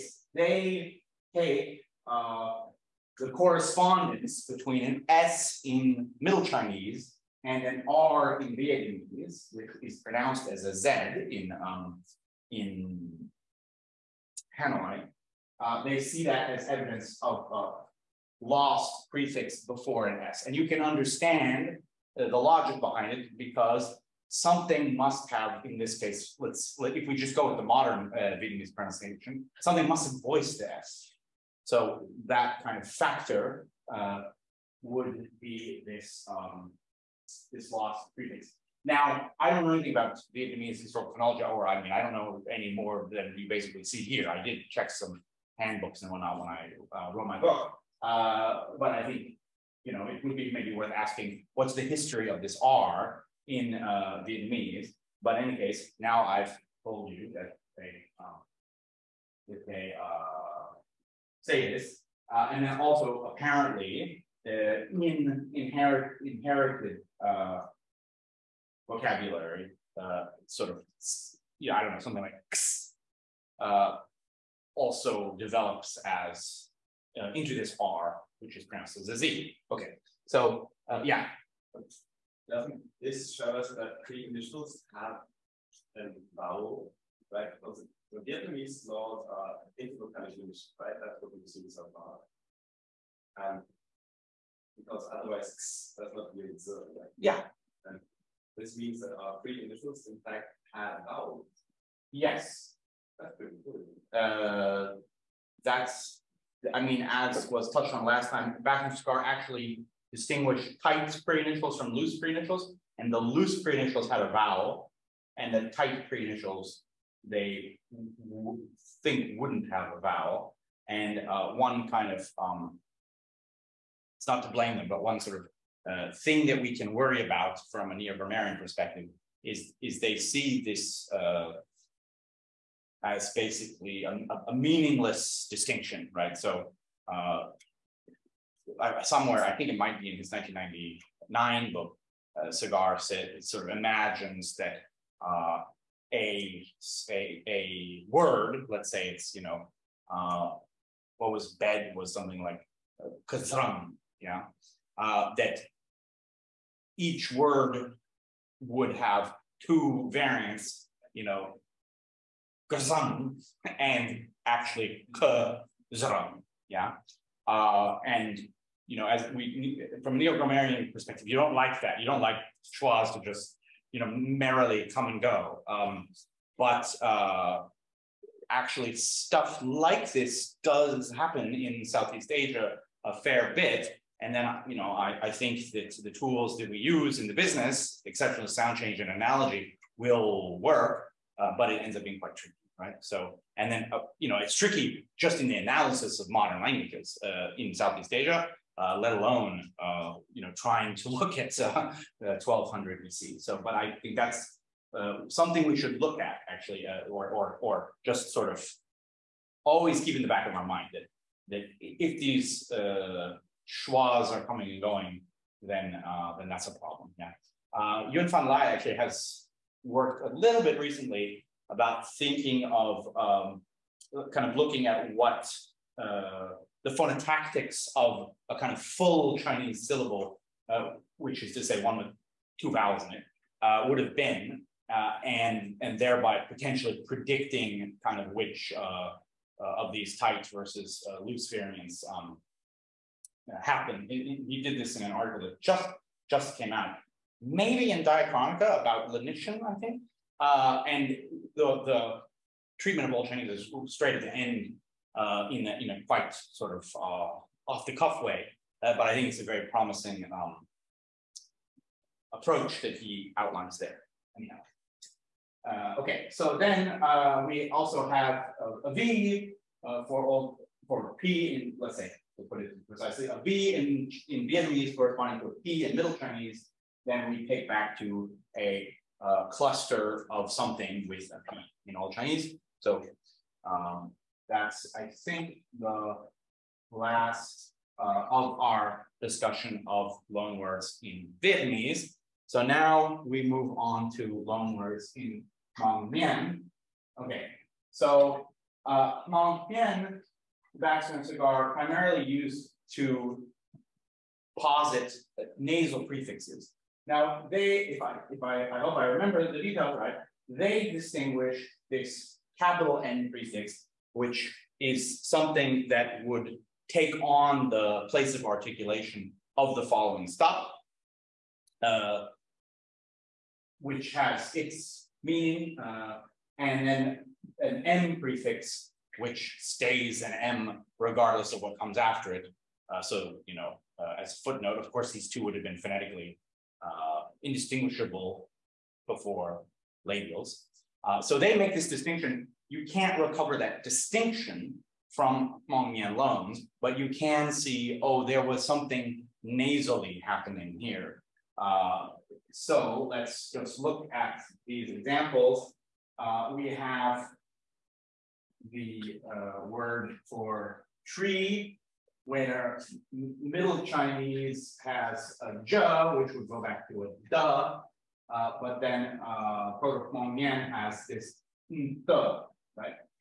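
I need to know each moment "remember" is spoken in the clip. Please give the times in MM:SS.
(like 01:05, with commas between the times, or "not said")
05:09.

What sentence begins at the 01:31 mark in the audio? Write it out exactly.
That's what we've seen so far.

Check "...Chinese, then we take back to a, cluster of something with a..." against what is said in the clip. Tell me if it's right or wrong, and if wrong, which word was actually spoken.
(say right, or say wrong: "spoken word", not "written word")
right.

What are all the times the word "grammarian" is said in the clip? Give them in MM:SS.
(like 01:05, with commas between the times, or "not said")
02:07, 02:50.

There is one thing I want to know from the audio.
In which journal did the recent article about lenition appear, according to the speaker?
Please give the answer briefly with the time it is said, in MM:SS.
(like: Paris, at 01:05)
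Diachronica, at 04:08.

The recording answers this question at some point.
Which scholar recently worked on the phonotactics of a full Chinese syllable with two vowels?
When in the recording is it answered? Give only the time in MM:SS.
03:38.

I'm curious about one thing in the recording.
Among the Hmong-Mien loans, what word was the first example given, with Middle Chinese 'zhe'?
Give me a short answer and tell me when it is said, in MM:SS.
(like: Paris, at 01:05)
tree, at 06:01.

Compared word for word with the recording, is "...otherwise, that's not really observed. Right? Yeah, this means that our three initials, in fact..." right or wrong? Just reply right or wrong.
right.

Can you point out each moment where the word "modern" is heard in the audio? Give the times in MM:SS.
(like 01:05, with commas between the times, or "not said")
00:27, 03:16.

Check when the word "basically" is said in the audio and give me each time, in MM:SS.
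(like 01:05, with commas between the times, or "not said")
00:43, 02:13.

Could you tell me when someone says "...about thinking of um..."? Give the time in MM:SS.
03:41.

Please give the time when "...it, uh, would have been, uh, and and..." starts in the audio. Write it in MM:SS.
03:53.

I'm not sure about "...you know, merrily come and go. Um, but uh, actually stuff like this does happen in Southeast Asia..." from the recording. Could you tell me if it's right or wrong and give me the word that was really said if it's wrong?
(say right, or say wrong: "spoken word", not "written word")
right.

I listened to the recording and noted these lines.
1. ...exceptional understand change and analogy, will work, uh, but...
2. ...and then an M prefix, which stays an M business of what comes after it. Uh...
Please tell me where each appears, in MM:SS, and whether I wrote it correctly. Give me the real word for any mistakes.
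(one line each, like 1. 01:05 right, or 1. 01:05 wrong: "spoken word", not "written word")
1. 03:08 wrong: "sound", not "understand"
2. 05:26 wrong: "regardless", not "business".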